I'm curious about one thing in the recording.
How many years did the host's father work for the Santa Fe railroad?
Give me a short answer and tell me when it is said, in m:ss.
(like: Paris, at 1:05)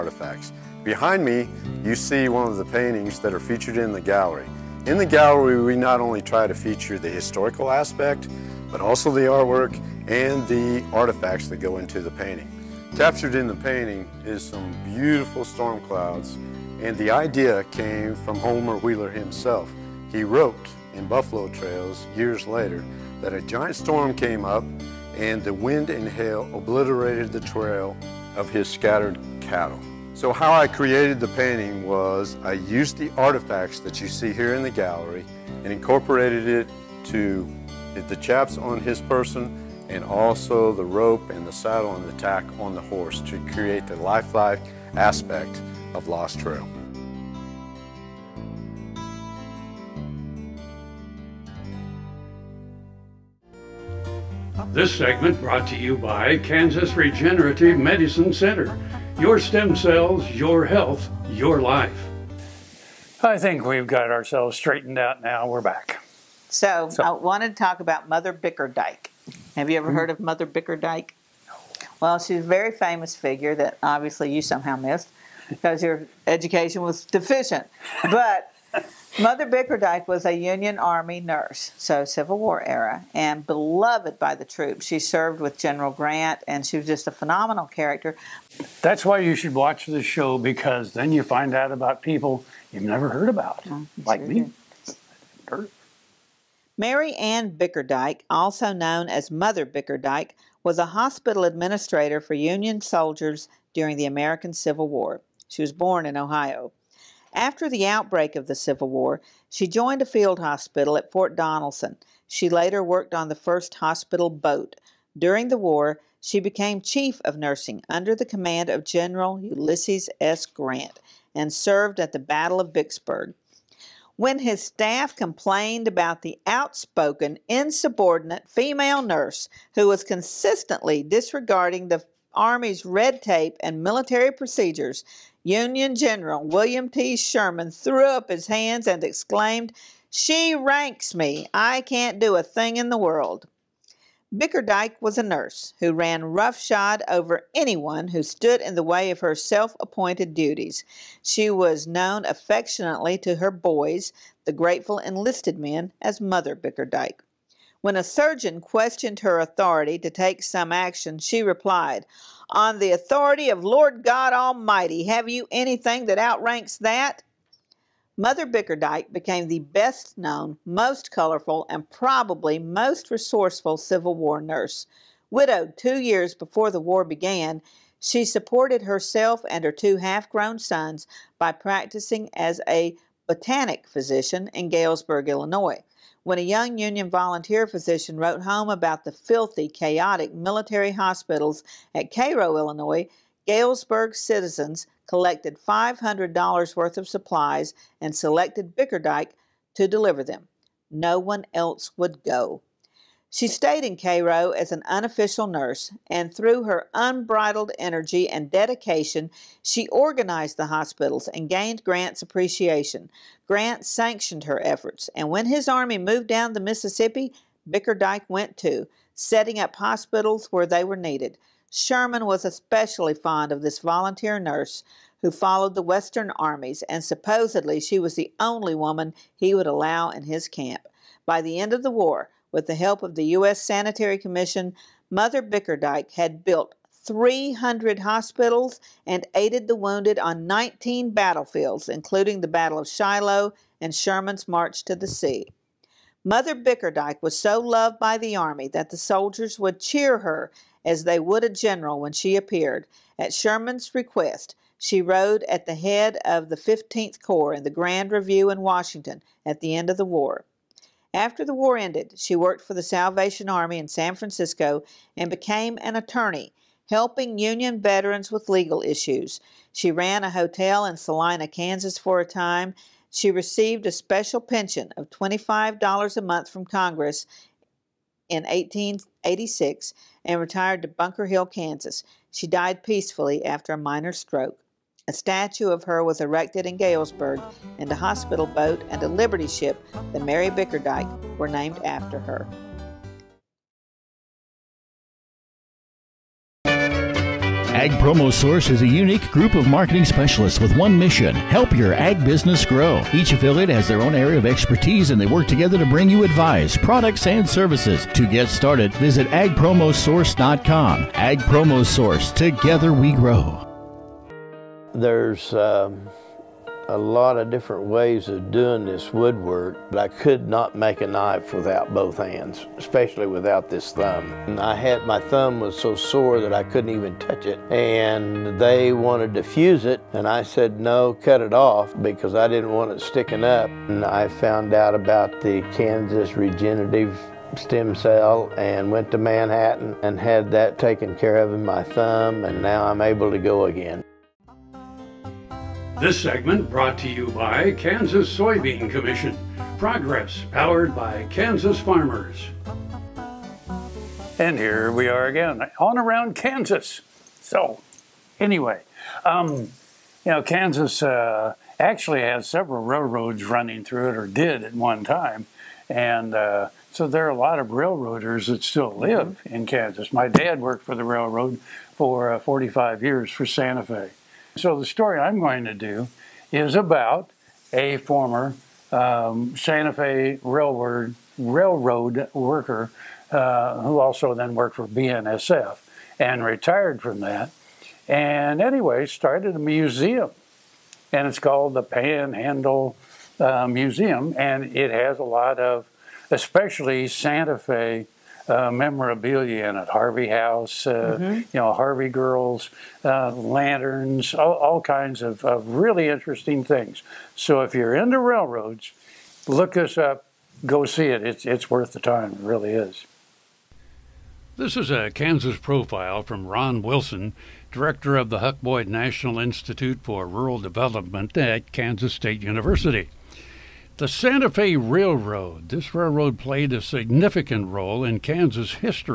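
45, at 6:12.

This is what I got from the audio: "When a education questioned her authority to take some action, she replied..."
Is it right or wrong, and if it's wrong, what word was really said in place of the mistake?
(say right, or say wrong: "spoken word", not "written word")
wrong: "surgeon", not "education".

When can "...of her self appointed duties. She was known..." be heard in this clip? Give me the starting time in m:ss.
2:29.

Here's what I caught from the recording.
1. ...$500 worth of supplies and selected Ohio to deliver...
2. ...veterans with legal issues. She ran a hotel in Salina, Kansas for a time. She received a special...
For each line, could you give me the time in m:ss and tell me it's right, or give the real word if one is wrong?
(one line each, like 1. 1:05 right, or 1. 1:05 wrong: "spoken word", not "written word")
1. 3:15 wrong: "Bickerdyke", not "Ohio"
2. 4:27 right.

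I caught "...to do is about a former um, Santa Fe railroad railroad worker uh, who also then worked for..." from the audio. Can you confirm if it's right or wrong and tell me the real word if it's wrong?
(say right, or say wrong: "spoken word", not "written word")
right.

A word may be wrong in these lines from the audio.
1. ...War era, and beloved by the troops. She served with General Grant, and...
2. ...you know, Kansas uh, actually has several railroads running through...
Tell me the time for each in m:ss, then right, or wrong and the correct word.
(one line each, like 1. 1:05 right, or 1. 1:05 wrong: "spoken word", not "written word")
1. 1:22 right
2. 5:59 right.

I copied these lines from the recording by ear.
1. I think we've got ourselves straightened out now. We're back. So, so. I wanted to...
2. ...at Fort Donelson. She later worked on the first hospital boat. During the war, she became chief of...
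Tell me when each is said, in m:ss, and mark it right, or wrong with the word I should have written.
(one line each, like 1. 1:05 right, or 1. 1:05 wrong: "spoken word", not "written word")
1. 1:03 right
2. 1:50 right.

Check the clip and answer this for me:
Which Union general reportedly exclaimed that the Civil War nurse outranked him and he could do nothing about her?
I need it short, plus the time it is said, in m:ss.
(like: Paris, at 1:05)
William T. Sherman, at 2:16.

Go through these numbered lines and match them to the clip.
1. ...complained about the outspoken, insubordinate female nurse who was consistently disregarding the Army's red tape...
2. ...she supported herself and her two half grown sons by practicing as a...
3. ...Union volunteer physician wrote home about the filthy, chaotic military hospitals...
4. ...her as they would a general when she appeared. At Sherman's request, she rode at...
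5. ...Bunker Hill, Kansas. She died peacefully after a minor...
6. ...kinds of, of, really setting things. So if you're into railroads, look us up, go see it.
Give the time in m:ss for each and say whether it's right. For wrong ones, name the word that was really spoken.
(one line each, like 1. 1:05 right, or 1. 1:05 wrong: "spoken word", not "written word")
1. 2:05 right
2. 2:57 right
3. 3:06 right
4. 4:10 right
5. 4:40 right
6. 6:44 wrong: "interesting", not "setting".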